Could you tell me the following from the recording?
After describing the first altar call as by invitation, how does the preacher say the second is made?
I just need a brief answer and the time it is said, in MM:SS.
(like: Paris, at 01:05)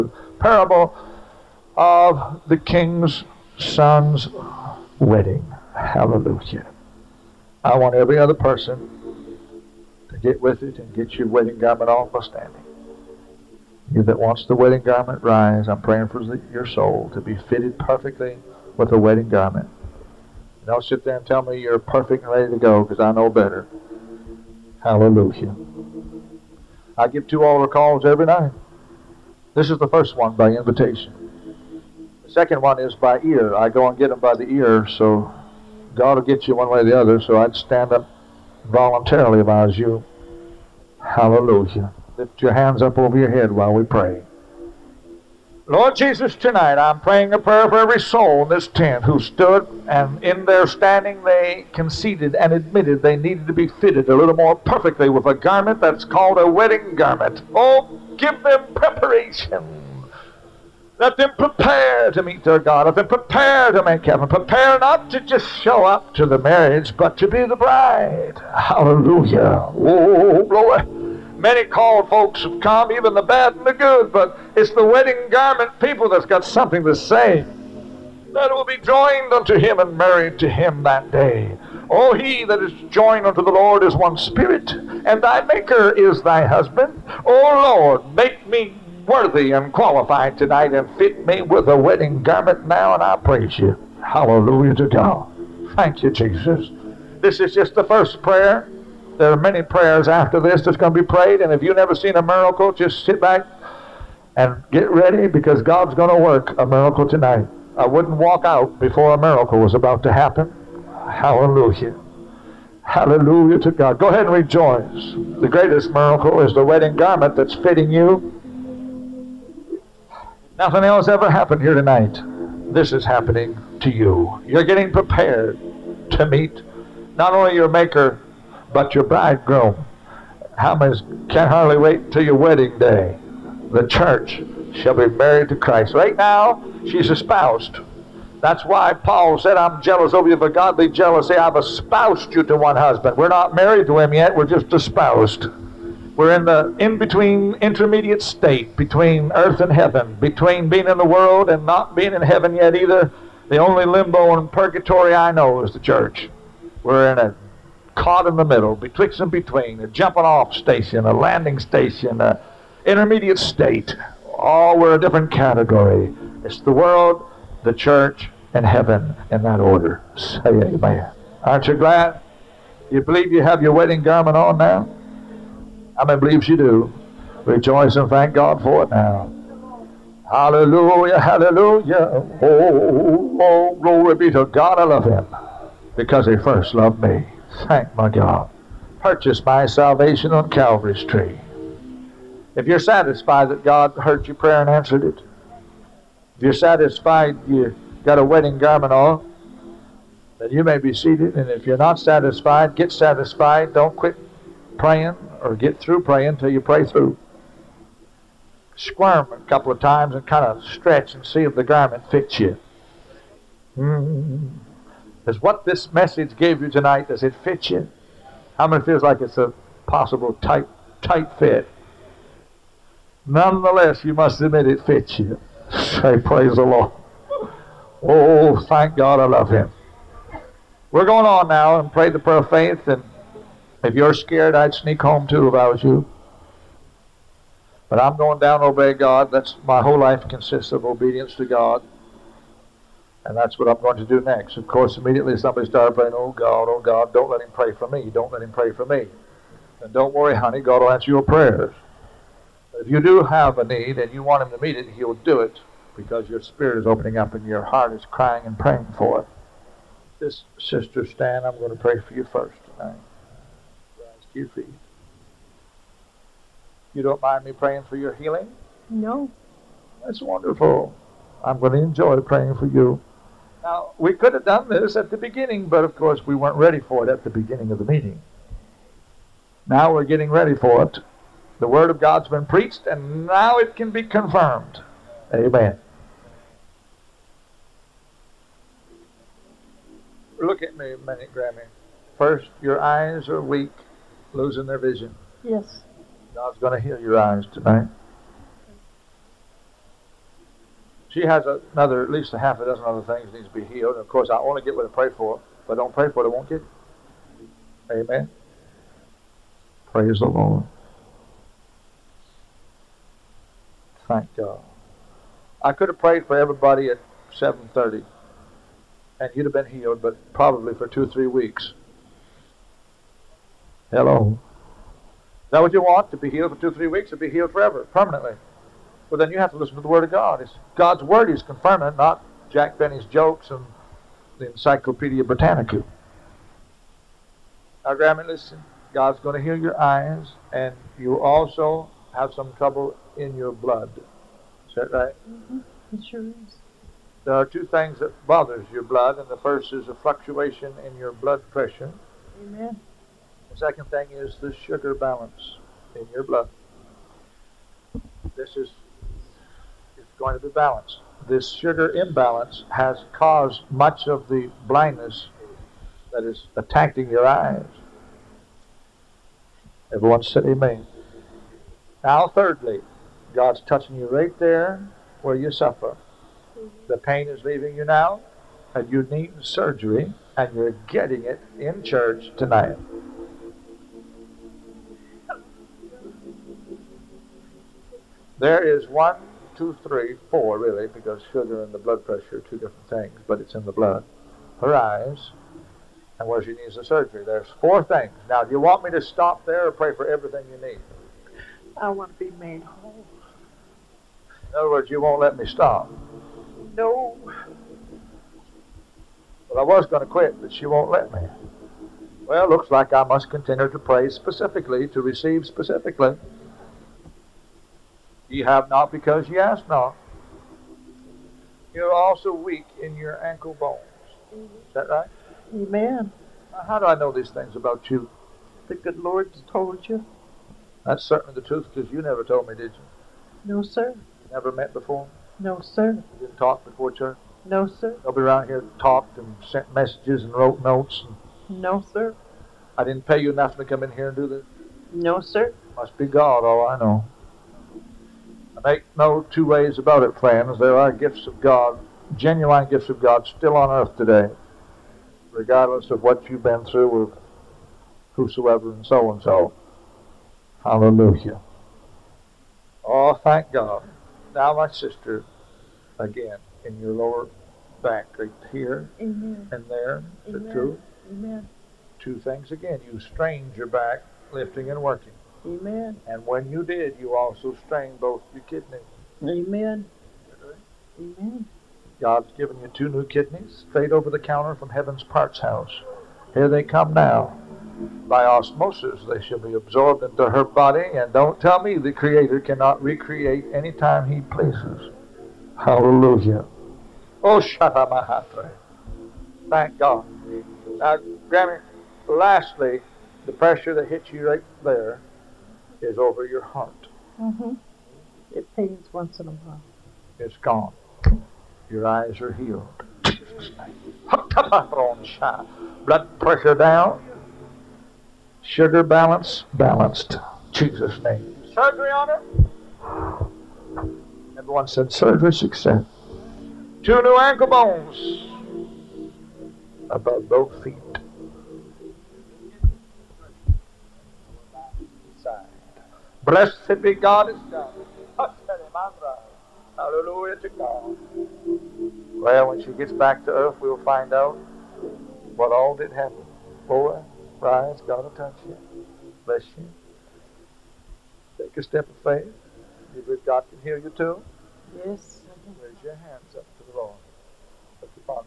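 By ear, at 00:32.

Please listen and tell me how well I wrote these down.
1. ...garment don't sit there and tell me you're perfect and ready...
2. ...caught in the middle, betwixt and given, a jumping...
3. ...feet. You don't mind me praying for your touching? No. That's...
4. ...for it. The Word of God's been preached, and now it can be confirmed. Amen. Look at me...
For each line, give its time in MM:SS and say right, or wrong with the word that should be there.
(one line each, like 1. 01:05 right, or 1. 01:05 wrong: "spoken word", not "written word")
1. 00:19 right
2. 02:37 wrong: "between", not "given"
3. 04:24 wrong: "healing", not "touching"
4. 04:40 right.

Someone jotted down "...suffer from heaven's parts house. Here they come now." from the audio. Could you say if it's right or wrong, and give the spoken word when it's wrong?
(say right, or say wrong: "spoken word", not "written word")
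wrong: "counter", not "suffer".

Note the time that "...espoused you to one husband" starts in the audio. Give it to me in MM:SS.
02:21.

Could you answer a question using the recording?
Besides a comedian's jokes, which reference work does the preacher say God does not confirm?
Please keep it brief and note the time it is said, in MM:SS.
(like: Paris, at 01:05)
Encyclopedia Britannica, at 05:34.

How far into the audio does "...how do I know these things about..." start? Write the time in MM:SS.
07:06.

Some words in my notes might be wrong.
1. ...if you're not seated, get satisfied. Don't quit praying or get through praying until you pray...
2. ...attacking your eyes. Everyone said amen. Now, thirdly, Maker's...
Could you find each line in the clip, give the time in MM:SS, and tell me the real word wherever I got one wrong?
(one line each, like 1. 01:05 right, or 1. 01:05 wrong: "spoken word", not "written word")
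1. 03:21 wrong: "satisfied", not "seated"
2. 06:06 wrong: "God", not "Maker".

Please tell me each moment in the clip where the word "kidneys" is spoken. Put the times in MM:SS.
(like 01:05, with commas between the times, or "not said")
07:58, 08:03.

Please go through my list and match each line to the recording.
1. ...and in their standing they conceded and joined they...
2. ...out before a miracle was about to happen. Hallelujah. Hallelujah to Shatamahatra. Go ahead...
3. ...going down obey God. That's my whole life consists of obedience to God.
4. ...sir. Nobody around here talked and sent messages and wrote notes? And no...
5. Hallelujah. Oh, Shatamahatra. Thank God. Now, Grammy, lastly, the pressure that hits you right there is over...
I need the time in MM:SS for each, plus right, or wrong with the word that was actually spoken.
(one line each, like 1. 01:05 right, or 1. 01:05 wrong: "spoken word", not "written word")
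1. 00:49 wrong: "admitted", not "joined"
2. 01:48 wrong: "God", not "Shatamahatra"
3. 03:58 right
4. 07:17 right
5. 08:15 right.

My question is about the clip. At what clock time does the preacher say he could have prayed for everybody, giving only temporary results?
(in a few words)
7:30.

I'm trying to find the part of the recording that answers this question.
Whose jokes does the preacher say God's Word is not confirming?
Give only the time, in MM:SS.
05:32.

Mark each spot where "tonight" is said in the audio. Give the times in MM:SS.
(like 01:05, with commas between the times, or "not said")
00:46, 01:30, 01:47, 02:01, 03:36, 04:22, 04:57, 06:22.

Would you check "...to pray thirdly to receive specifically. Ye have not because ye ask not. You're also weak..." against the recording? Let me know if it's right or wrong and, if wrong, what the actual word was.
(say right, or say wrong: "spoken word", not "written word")
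wrong: "specifically", not "thirdly".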